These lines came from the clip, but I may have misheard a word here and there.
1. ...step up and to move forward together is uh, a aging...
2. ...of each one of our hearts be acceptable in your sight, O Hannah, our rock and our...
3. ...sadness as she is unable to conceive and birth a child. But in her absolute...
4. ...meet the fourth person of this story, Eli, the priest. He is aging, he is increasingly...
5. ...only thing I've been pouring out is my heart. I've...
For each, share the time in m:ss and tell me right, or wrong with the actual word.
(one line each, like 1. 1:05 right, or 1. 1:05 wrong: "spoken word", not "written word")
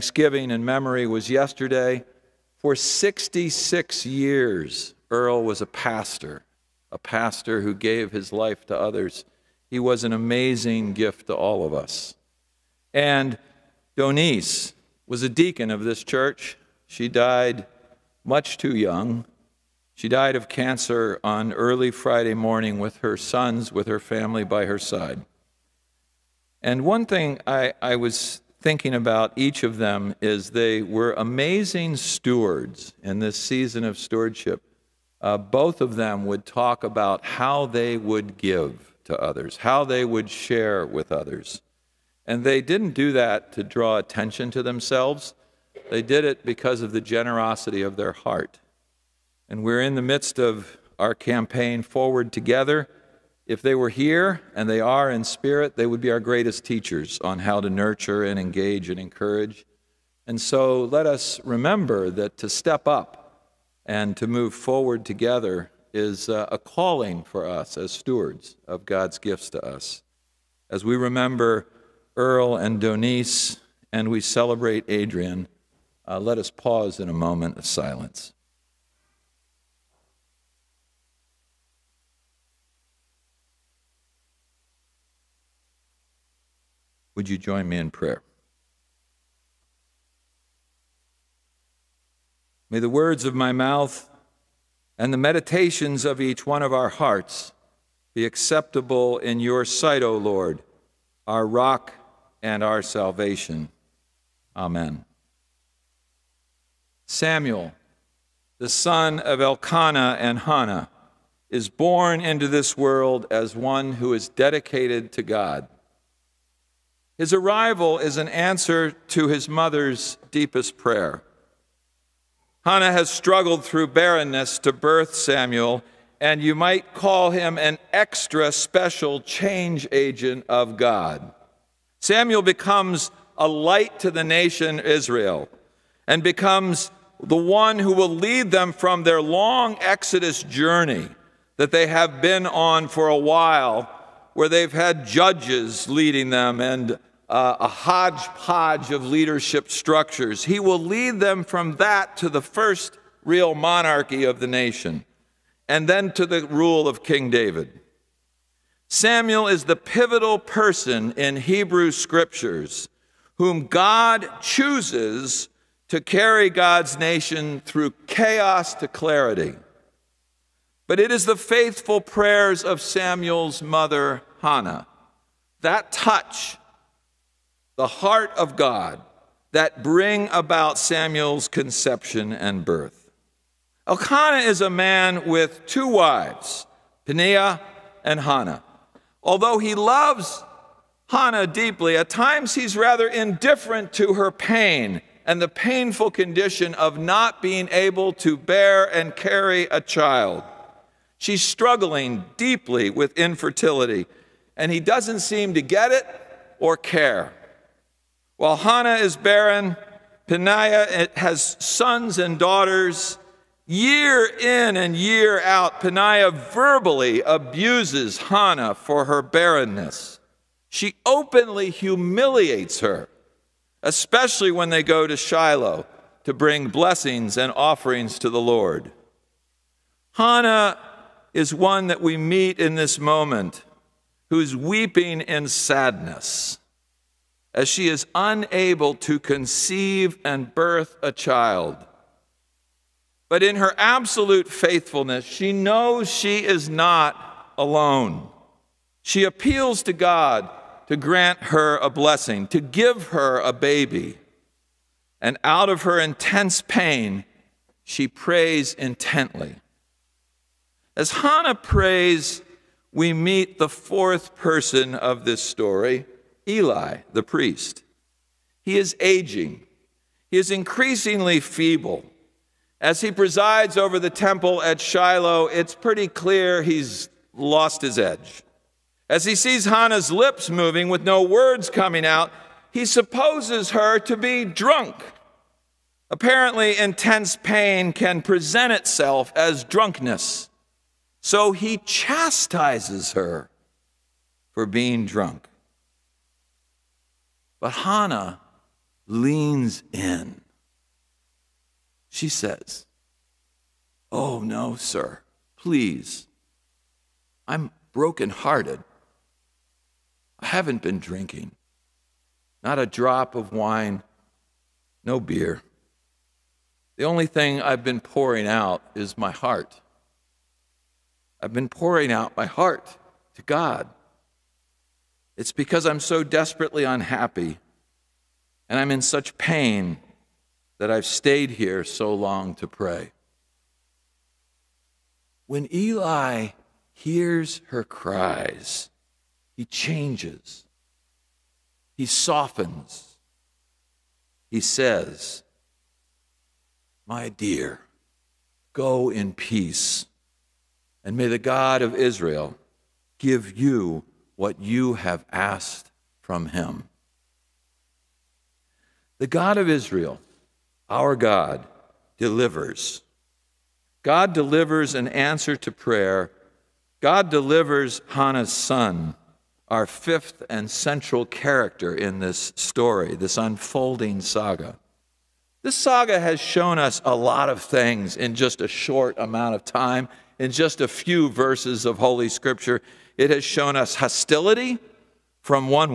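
1. 1:02 wrong: "calling", not "aging"
2. 1:36 wrong: "Lord", not "Hannah"
3. 3:55 right
4. 4:23 right
5. 5:17 right.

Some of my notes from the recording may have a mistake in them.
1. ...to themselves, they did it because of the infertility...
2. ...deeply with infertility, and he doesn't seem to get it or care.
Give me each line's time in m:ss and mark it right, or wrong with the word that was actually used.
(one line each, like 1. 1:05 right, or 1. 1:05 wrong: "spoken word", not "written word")
1. 0:44 wrong: "generosity", not "infertility"
2. 3:22 right.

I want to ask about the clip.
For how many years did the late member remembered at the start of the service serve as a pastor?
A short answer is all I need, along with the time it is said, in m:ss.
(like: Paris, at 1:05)
66, at 0:02.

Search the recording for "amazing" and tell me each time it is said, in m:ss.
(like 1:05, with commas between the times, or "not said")
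0:10, 0:31.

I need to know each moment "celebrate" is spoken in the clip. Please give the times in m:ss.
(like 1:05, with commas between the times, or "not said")
1:14.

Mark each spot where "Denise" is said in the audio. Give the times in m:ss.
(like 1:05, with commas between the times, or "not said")
0:13, 1:12.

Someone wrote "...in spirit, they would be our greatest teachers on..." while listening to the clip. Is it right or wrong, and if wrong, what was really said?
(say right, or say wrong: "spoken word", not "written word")
right.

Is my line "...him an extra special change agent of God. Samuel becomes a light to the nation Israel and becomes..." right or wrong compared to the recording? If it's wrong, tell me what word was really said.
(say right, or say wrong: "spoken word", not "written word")
right.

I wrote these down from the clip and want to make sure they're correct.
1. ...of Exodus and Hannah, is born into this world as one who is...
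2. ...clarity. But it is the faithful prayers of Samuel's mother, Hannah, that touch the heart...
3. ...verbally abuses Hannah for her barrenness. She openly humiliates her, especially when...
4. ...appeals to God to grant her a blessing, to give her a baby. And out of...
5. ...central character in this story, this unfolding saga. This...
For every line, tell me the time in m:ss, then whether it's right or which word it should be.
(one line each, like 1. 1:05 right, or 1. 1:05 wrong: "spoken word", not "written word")
1. 1:49 wrong: "Elkanah", not "Exodus"
2. 2:48 right
3. 3:36 right
4. 4:09 right
5. 6:10 right.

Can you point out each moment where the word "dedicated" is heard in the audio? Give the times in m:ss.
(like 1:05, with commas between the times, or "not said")
1:54.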